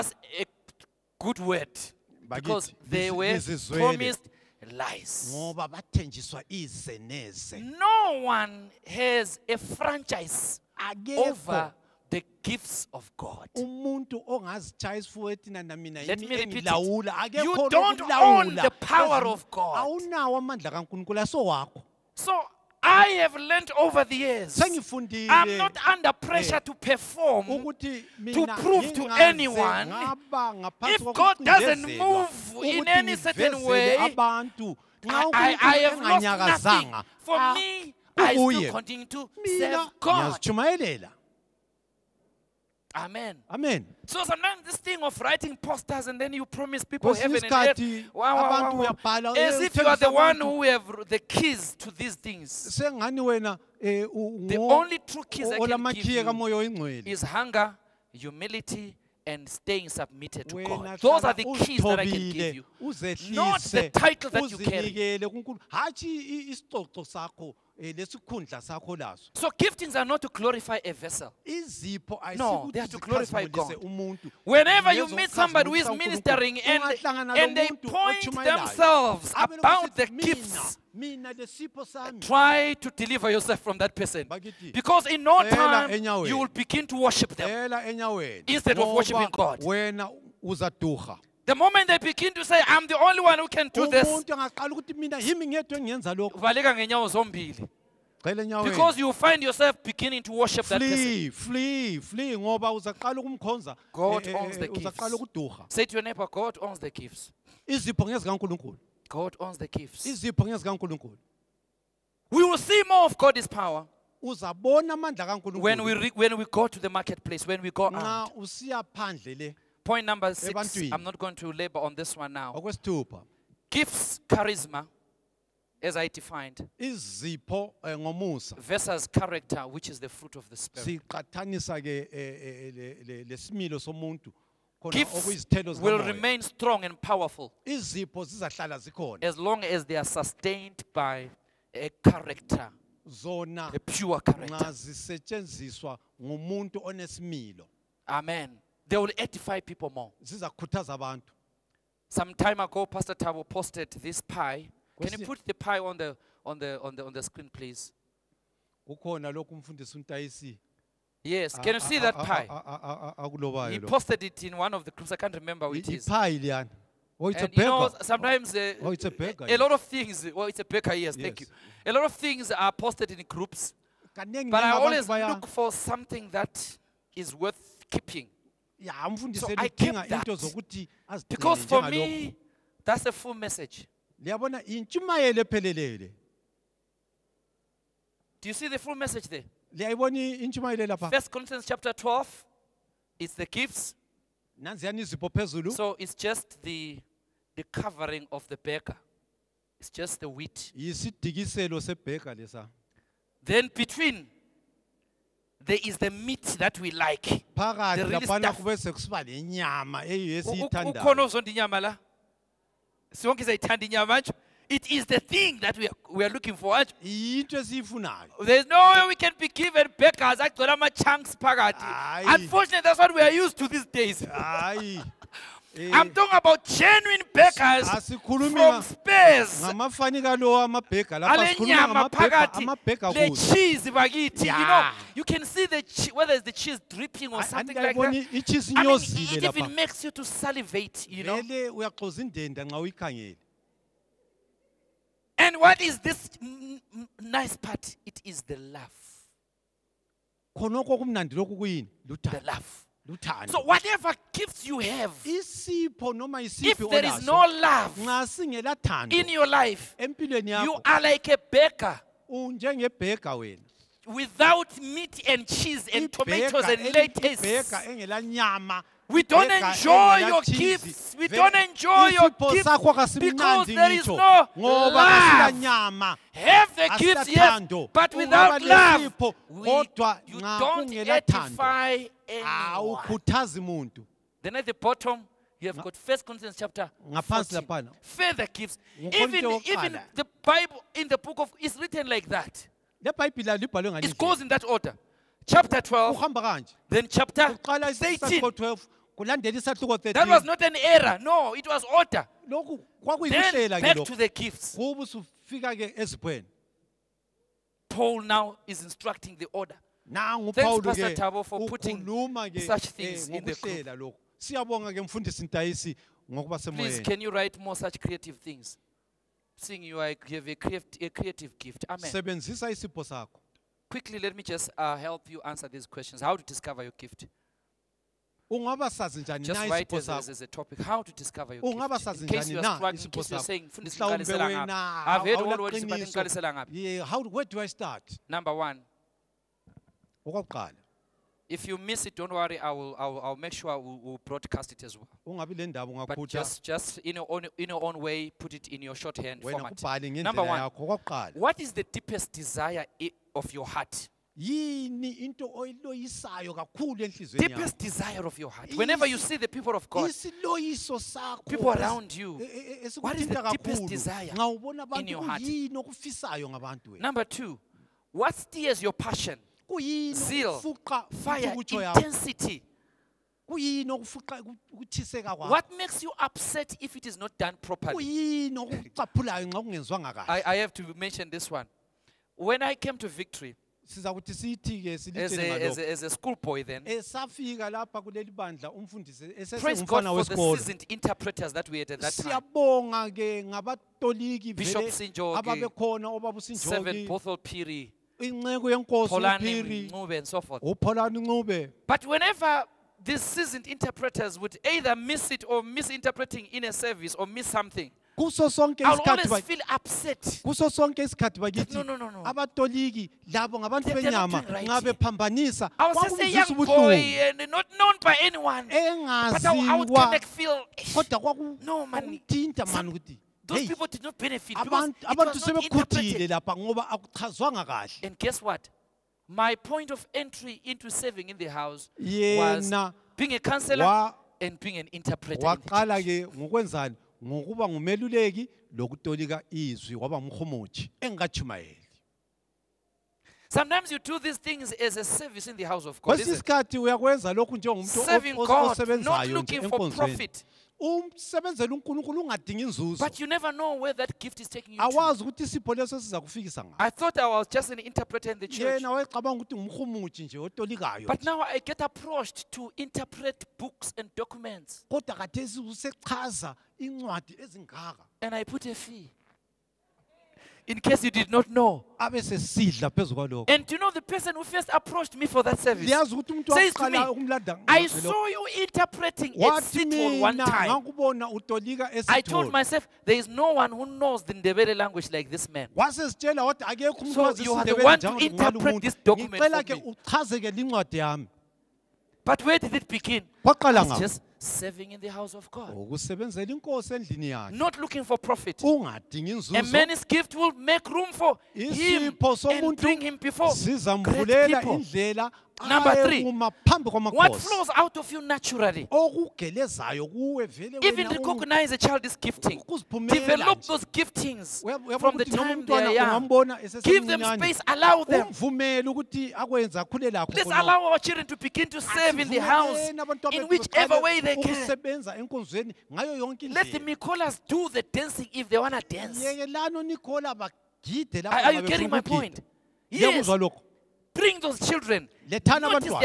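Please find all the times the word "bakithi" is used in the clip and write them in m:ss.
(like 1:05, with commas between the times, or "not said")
3:53, 6:51.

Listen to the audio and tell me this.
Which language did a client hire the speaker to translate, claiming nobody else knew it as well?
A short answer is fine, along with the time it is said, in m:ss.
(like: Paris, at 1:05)
Ndebele, at 8:04.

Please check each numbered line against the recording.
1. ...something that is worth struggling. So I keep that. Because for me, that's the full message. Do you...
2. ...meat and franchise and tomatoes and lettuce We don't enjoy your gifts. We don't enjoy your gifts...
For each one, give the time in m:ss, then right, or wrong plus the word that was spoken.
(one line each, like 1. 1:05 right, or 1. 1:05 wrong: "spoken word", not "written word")
1. 2:55 wrong: "keeping", not "struggling"
2. 4:24 wrong: "cheese", not "franchise".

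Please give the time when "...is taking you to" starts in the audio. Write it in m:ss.
7:34.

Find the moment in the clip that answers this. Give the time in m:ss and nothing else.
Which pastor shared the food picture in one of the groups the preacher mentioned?
2:32.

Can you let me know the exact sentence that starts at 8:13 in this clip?
It's just serving in the house of God.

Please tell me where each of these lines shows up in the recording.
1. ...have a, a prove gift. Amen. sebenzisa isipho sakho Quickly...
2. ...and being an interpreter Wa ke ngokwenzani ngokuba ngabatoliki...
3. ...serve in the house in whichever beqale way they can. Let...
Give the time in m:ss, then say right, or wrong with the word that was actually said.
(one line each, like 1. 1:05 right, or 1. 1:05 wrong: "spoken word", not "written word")
1. 5:20 wrong: "creative", not "prove"
2. 7:14 wrong: "ngumeluleki", not "ngabatoliki"
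3. 8:41 right.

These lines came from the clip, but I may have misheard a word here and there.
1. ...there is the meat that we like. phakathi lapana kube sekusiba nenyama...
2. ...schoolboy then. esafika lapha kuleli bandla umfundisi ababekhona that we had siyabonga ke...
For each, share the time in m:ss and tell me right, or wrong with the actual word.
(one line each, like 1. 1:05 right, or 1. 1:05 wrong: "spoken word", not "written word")
1. 3:25 right
2. 6:26 wrong: "esesengumfana", not "ababekhona".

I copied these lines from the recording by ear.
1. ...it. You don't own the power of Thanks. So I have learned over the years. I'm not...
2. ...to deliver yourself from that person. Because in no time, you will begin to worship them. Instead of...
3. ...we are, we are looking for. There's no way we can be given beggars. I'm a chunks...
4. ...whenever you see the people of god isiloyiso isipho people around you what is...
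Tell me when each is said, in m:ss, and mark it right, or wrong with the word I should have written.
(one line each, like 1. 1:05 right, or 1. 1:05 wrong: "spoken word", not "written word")
1. 0:16 wrong: "God", not "Thanks"
2. 1:22 right
3. 3:35 right
4. 5:58 wrong: "sakho", not "isipho".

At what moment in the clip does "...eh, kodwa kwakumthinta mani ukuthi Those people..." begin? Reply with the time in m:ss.
6:58.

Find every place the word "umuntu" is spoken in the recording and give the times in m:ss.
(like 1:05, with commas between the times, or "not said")
1:13, 7:56, 8:07.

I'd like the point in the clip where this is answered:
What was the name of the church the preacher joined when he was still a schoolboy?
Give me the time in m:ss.
6:23.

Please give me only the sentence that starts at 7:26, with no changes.
Kwesinye isikhathi uyakwenza lokhu njengomuntu osebenzayo enkonzweni.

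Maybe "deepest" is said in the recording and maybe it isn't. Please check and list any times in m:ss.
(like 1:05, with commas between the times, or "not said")
5:51, 5:57, 6:03.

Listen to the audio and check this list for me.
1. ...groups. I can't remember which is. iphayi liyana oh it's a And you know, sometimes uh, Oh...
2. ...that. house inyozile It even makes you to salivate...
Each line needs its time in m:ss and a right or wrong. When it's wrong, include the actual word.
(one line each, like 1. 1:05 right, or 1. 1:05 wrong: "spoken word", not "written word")
1. 2:44 right
2. 3:57 wrong: "icheese", not "house".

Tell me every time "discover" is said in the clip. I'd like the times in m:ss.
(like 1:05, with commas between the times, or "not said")
5:26, 5:31.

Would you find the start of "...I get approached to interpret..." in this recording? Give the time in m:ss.
7:41.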